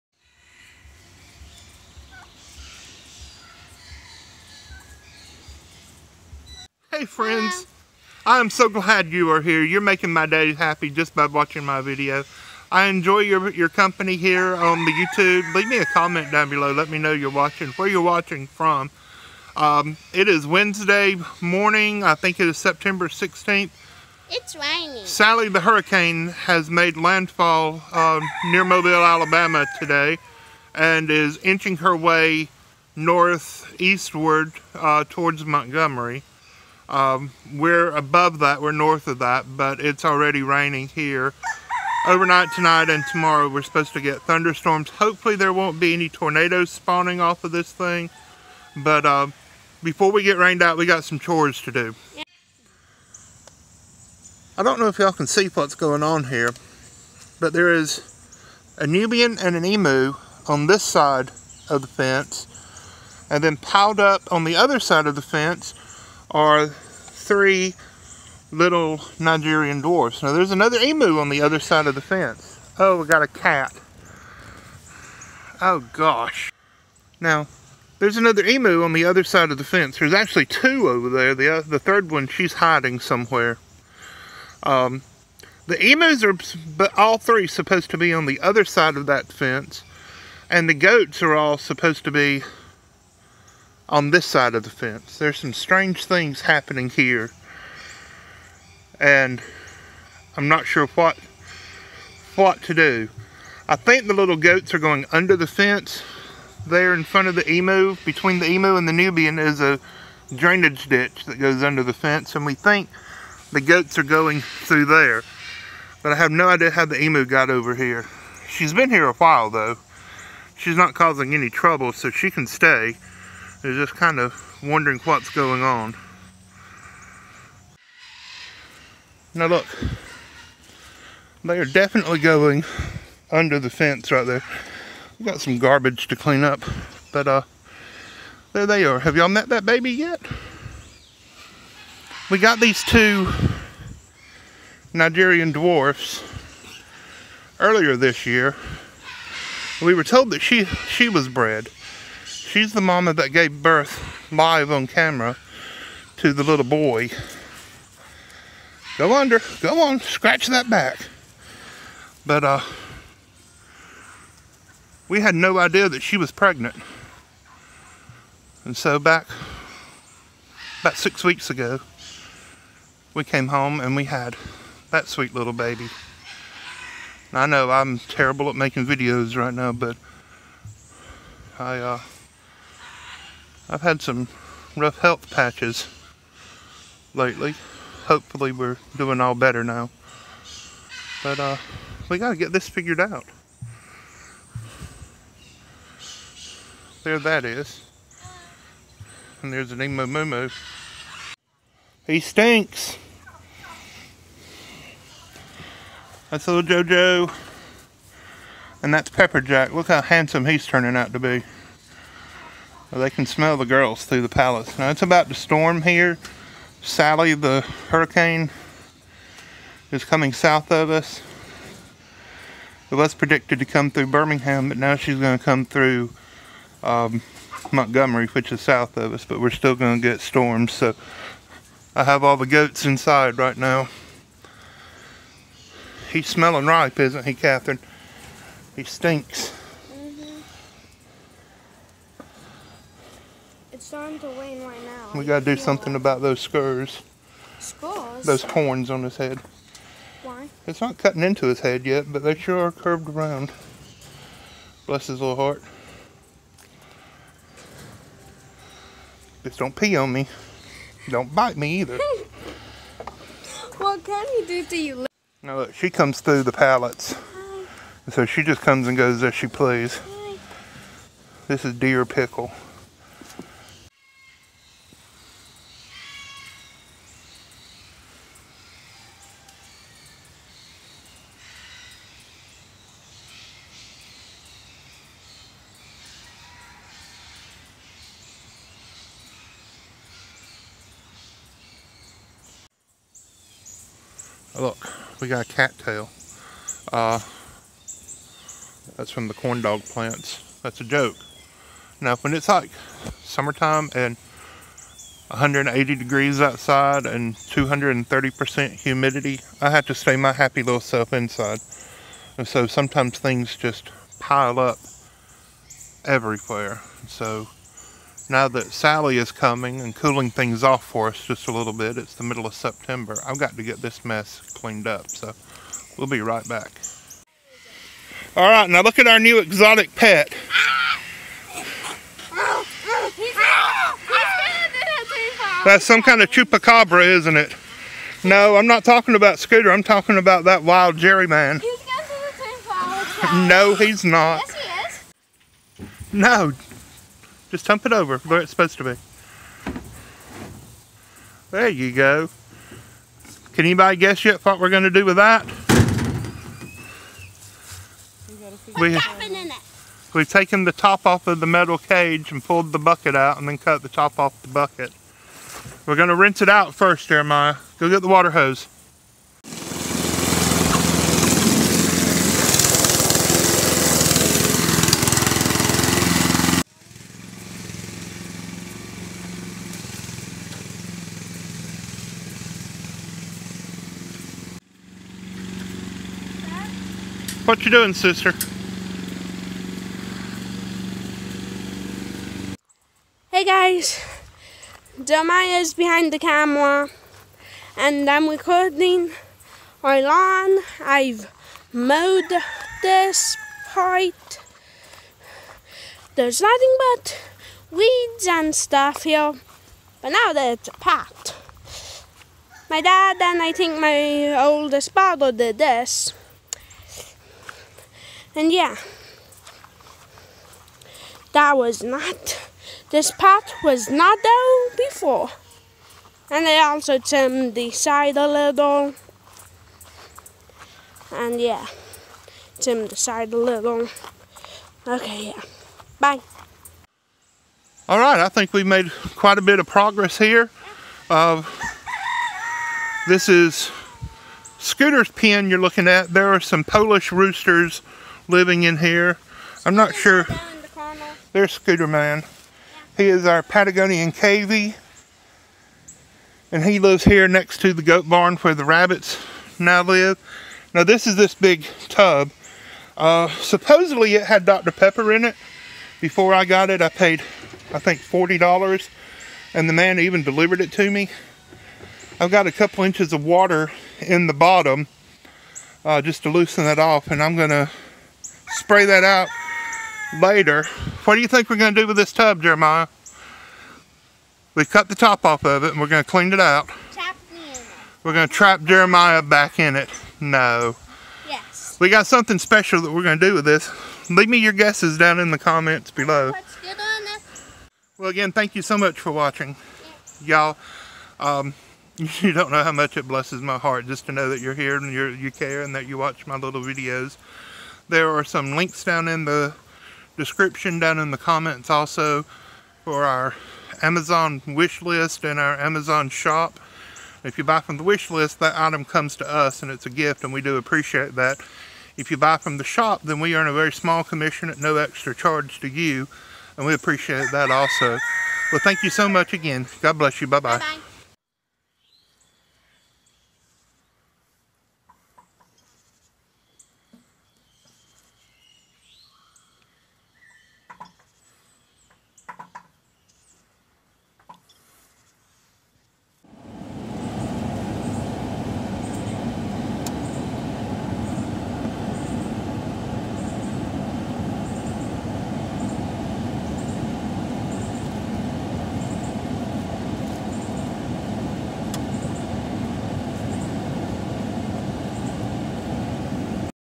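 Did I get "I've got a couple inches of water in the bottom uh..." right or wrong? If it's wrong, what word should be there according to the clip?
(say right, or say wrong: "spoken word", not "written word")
right.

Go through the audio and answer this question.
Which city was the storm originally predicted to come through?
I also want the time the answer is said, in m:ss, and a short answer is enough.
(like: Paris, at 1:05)
Birmingham, at 3:44.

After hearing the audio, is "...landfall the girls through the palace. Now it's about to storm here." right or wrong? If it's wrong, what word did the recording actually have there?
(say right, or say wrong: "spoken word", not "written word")
wrong: "smell", not "landfall".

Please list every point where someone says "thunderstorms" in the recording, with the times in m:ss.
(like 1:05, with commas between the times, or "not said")
0:44.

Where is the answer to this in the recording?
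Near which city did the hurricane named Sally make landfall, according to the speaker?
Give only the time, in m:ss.
0:28.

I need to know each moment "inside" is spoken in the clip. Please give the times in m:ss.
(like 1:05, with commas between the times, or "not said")
3:52, 5:11.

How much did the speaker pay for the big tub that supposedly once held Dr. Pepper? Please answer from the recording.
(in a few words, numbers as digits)
$40.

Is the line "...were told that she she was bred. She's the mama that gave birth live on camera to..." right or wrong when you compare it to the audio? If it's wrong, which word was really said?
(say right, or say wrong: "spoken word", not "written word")
right.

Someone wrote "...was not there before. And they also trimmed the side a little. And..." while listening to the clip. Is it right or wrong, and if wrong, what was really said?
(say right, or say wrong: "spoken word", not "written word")
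right.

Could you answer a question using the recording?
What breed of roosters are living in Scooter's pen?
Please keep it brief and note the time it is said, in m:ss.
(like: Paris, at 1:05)
Polish, at 7:26.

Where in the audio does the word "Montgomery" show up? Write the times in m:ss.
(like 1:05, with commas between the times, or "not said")
0:35, 3:47.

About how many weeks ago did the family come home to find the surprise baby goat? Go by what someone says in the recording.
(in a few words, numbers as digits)
6.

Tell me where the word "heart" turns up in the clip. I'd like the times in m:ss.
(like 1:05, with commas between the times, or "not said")
4:15, 8:23.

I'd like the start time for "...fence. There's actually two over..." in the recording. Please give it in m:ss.
1:19.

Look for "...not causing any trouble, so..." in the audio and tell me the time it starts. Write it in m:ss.
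2:00.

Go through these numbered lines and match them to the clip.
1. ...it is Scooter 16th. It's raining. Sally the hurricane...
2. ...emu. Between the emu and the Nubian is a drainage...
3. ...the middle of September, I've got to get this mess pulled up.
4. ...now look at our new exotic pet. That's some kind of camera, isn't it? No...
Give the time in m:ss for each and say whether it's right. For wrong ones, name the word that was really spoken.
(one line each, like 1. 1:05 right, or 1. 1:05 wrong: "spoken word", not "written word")
1. 0:22 wrong: "September", not "Scooter"
2. 1:47 right
3. 5:22 wrong: "cleaned", not "pulled"
4. 5:28 wrong: "chupacabra", not "camera".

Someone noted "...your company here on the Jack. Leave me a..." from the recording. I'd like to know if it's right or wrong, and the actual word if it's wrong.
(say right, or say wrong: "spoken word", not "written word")
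wrong: "YouTube", not "Jack".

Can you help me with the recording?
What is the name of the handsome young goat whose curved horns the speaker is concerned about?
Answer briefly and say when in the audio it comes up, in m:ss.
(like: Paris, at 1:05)
Pepper Jack, at 3:29.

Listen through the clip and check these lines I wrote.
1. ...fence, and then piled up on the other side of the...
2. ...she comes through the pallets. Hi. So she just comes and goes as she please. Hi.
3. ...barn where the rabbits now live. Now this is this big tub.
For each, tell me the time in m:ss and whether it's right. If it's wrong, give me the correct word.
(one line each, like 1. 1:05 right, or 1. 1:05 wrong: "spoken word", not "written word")
1. 1:01 right
2. 4:25 right
3. 7:38 right.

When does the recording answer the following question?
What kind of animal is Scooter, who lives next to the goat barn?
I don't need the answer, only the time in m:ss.
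7:33.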